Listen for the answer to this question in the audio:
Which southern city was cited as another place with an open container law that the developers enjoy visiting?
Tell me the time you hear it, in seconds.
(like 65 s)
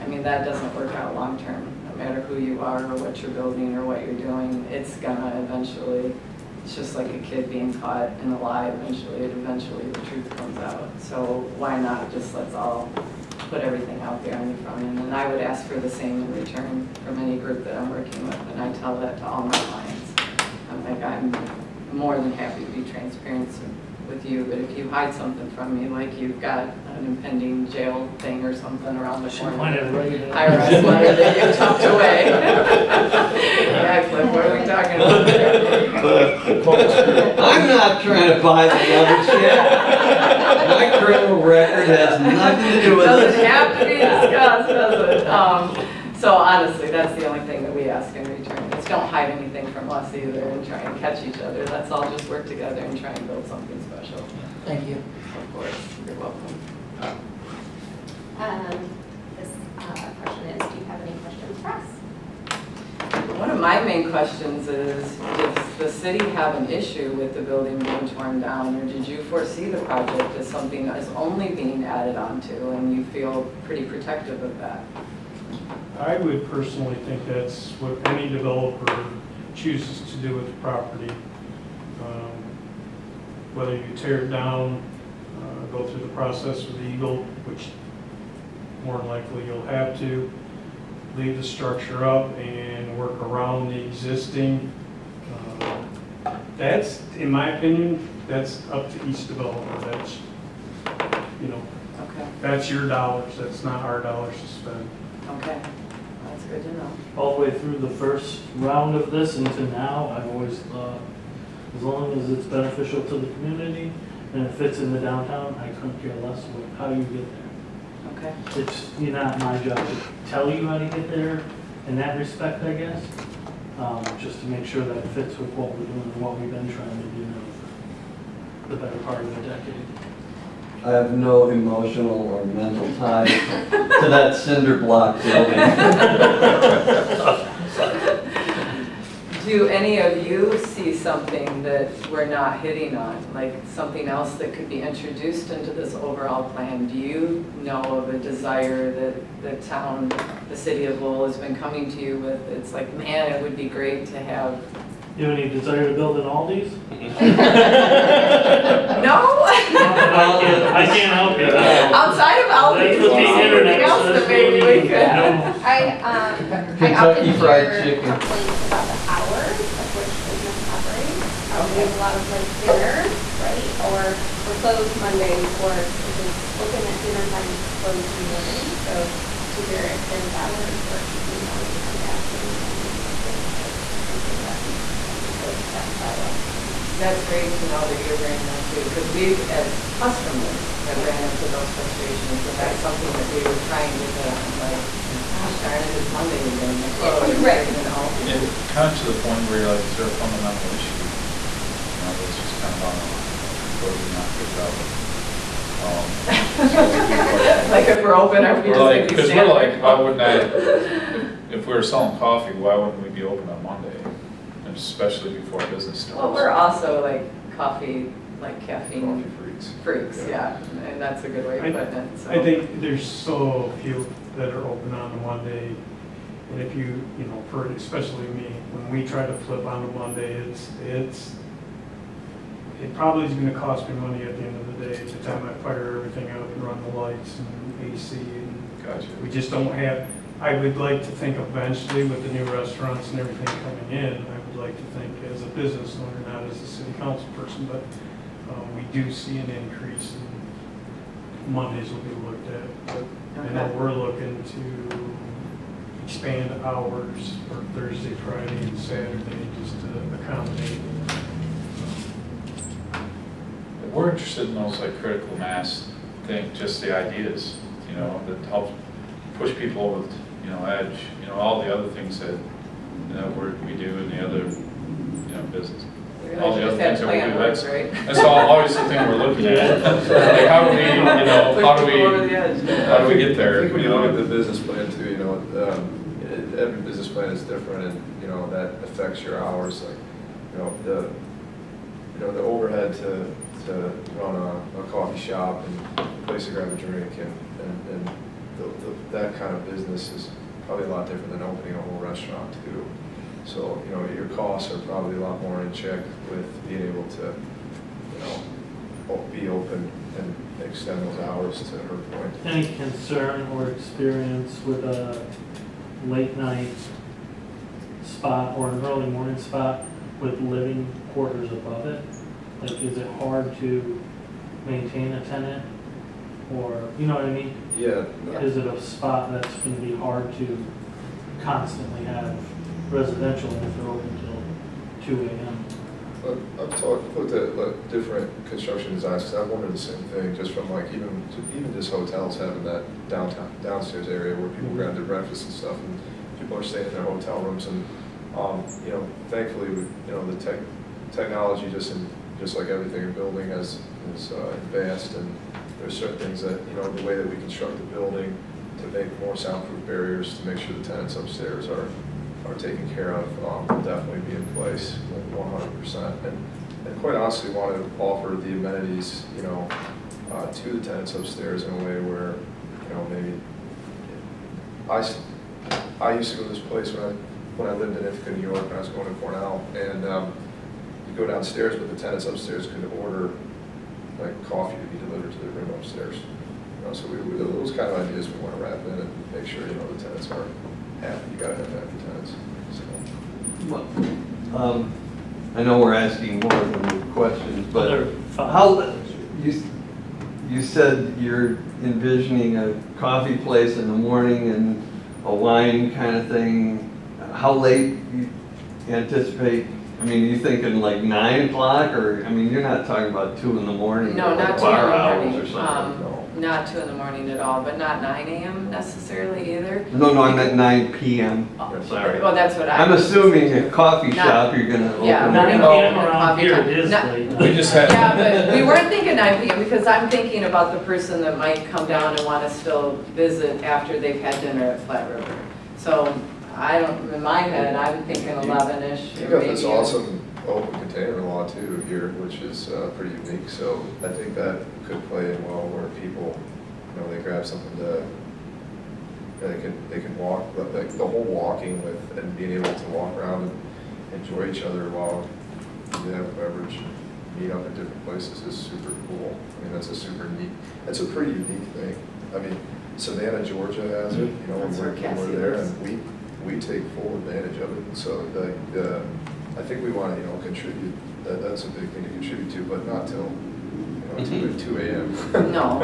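462 s.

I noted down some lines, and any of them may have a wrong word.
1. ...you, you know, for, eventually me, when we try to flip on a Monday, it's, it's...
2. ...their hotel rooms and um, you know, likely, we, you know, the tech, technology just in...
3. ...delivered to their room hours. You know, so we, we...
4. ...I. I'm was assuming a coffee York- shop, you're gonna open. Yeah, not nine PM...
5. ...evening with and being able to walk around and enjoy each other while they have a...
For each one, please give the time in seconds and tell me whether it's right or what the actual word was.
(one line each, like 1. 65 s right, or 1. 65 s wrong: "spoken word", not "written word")
1. 226 s wrong: "especially", not "eventually"
2. 346 s wrong: "thankfully", not "likely"
3. 385 s wrong: "upstairs", not "hours"
4. 422 s wrong: "Not", not "York"
5. 451 s wrong: "walking", not "evening".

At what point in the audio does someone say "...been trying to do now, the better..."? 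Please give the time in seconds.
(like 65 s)
126 s.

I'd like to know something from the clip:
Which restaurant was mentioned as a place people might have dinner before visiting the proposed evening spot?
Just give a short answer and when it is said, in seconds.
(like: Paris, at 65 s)
Flat River, at 434 s.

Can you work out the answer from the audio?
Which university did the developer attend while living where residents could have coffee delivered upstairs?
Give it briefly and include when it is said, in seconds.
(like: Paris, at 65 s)
Cornell, at 379 s.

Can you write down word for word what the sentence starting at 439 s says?
You got this awesome open container law too here, which is uh, pretty unique.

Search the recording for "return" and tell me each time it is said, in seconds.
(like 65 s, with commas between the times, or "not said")
16 s, 48 s.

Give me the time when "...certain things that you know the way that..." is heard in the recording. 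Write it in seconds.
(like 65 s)
355 s.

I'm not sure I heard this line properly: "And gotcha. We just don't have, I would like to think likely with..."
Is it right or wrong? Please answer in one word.
wrong.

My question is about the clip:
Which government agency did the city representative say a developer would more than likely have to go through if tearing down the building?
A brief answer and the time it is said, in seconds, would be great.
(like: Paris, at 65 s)
EGLE, at 86 s.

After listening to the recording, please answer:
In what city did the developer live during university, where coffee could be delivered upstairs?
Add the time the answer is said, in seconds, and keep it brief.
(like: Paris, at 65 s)
Ithaca, New York, at 378 s.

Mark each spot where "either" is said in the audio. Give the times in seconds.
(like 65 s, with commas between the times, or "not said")
50 s, 419 s.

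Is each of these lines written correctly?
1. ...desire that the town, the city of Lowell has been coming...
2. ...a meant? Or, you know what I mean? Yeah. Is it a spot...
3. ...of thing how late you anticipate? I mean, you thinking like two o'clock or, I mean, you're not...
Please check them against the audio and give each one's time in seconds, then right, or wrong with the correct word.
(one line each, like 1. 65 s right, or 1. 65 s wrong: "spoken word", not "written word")
1. 148 s right
2. 325 s wrong: "tenant", not "meant"
3. 406 s wrong: "nine", not "two".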